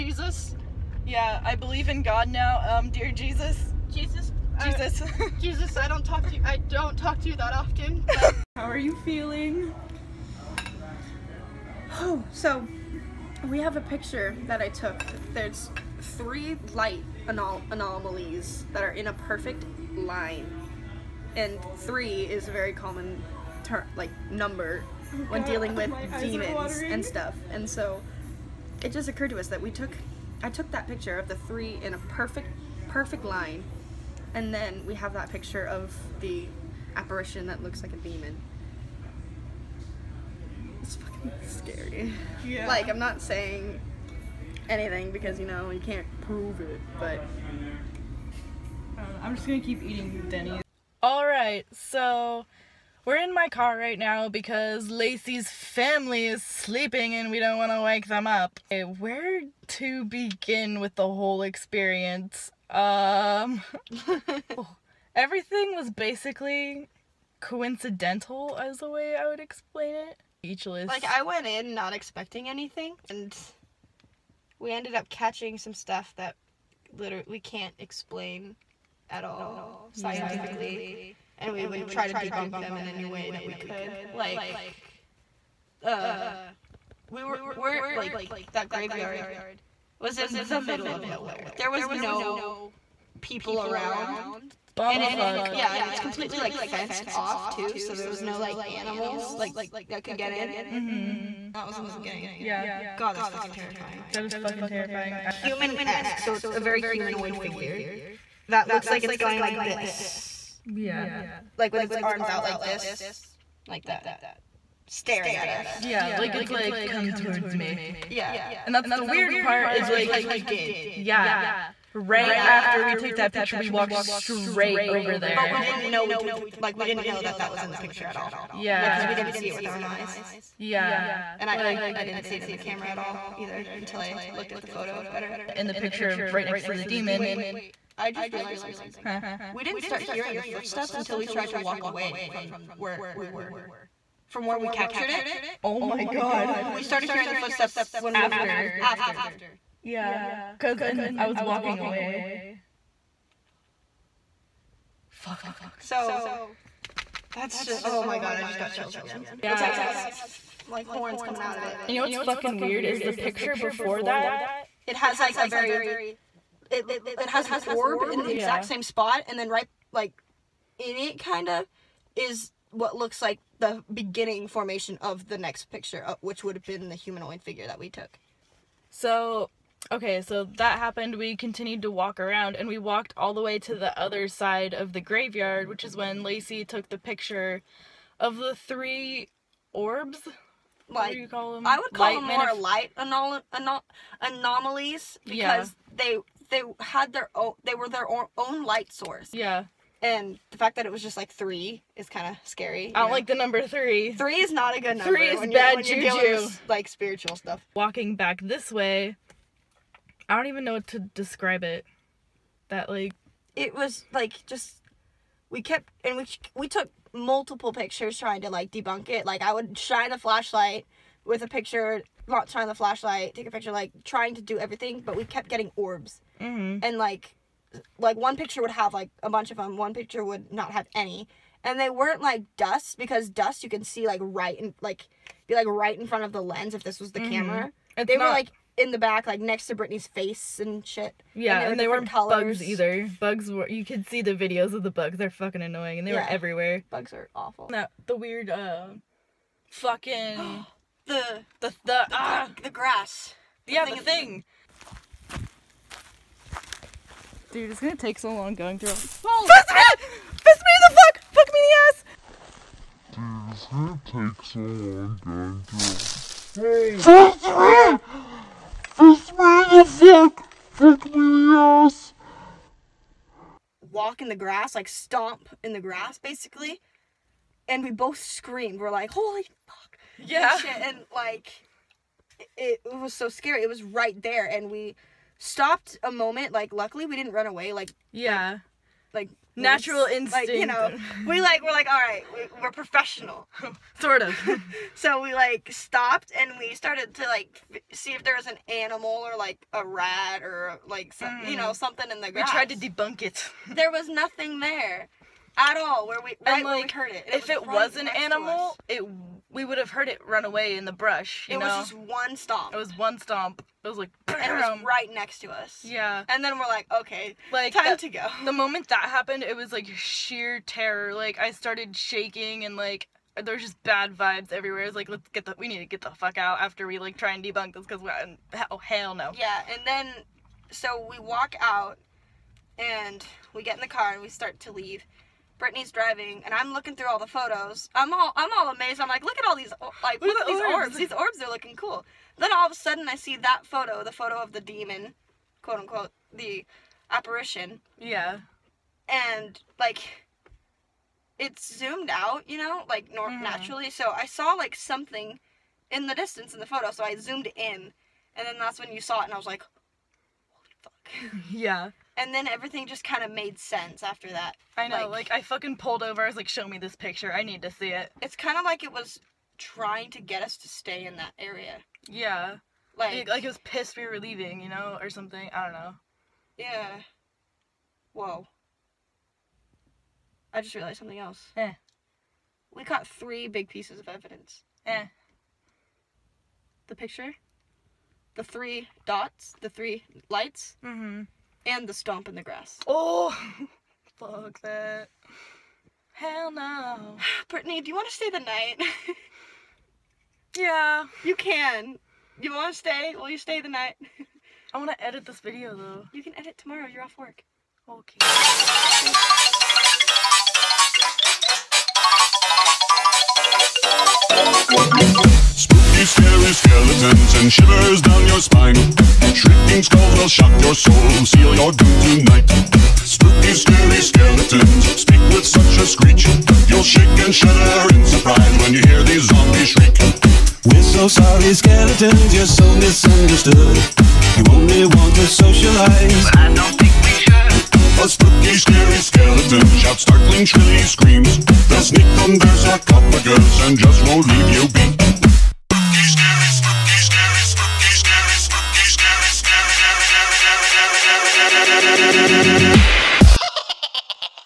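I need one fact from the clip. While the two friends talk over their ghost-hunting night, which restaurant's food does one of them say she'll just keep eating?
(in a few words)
Denny's.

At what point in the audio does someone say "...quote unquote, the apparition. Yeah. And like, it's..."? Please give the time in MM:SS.
05:45.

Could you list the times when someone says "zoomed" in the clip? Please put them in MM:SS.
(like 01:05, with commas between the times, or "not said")
05:51, 05:57.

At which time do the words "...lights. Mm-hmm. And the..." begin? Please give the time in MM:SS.
06:30.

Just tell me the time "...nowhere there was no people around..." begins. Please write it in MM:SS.
01:31.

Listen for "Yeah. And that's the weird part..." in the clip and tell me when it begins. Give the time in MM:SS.
01:58.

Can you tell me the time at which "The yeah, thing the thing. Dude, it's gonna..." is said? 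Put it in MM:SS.
04:13.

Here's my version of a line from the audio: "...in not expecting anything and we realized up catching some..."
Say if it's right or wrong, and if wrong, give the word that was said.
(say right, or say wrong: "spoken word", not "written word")
wrong: "ended", not "realized".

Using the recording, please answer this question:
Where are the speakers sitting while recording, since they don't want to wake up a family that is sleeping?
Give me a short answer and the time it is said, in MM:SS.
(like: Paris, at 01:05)
In my car, at 00:53.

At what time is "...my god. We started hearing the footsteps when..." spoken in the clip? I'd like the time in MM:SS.
02:25.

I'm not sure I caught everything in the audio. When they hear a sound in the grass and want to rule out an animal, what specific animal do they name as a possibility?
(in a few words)
Rat.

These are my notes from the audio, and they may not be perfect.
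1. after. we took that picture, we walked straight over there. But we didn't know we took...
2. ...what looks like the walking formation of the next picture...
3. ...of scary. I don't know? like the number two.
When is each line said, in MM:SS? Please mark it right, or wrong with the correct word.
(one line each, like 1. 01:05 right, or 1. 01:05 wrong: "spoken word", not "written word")
1. 02:02 right
2. 02:52 wrong: "beginning", not "walking"
3. 03:22 wrong: "three", not "two".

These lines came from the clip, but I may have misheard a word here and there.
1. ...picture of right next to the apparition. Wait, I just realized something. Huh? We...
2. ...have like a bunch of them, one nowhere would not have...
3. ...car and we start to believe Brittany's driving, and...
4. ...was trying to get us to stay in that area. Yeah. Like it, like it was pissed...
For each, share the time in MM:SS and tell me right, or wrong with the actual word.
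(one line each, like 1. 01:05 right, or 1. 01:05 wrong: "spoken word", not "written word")
1. 02:15 wrong: "demon", not "apparition"
2. 03:48 wrong: "picture", not "nowhere"
3. 05:33 wrong: "leave", not "believe"
4. 06:08 right.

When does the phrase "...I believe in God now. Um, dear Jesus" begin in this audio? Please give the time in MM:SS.
00:01.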